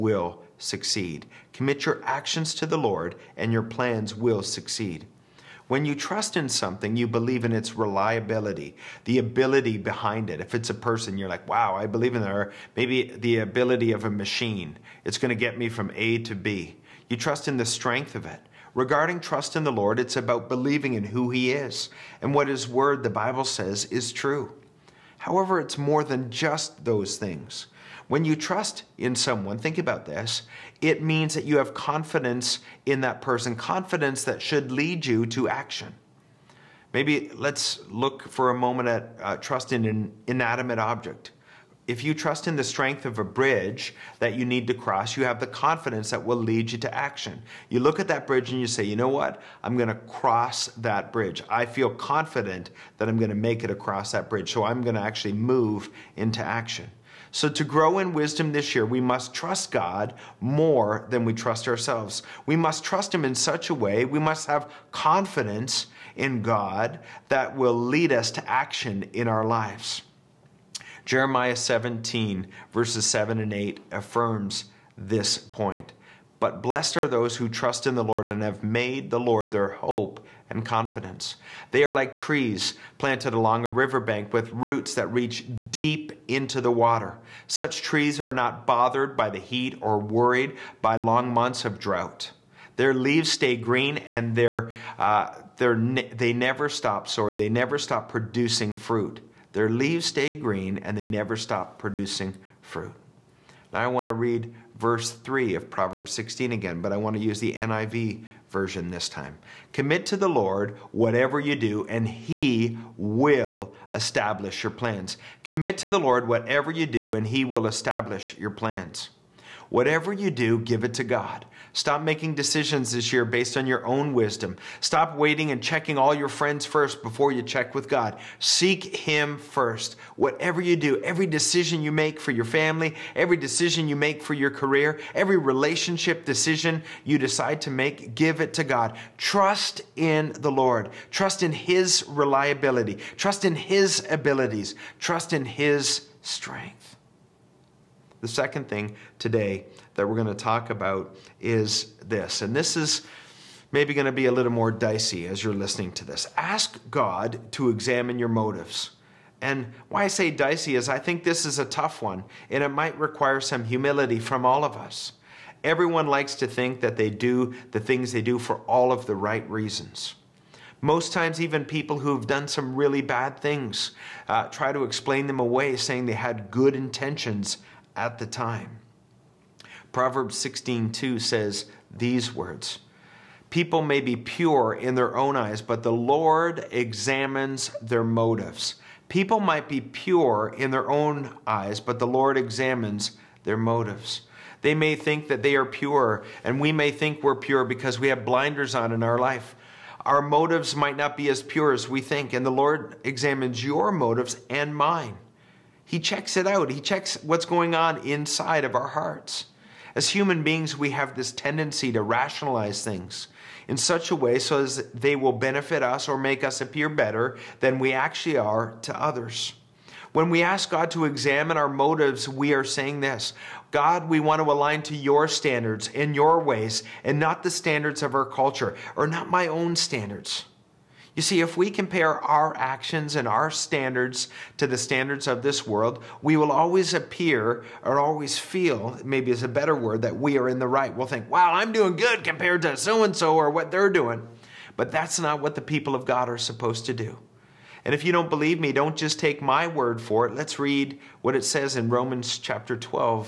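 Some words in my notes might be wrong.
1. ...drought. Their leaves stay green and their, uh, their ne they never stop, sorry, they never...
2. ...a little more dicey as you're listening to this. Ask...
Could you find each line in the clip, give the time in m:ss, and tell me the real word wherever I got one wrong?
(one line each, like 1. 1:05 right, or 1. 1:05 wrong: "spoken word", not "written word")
1. 1:31 right
2. 2:34 right.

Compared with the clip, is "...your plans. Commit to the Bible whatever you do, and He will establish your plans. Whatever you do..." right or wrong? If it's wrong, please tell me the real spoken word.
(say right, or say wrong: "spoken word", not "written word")
wrong: "Lord", not "Bible".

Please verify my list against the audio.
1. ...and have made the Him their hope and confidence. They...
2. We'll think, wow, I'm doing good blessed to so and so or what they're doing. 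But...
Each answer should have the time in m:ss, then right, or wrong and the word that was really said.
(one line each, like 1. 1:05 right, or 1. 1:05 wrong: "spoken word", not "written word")
1. 1:18 wrong: "Lord", not "Him"
2. 4:00 wrong: "compared", not "blessed".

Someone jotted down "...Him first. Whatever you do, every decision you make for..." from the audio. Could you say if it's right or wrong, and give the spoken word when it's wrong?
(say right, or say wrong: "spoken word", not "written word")
right.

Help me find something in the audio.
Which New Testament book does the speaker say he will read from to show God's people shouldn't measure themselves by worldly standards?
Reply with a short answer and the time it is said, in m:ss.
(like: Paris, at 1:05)
Romans, at 4:11.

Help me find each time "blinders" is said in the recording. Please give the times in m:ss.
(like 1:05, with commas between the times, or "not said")
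3:18.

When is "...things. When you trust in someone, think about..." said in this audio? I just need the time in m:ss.
0:27.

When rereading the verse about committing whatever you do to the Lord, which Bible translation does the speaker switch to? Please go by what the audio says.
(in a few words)
NIV.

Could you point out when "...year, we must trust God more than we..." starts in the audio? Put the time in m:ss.
0:58.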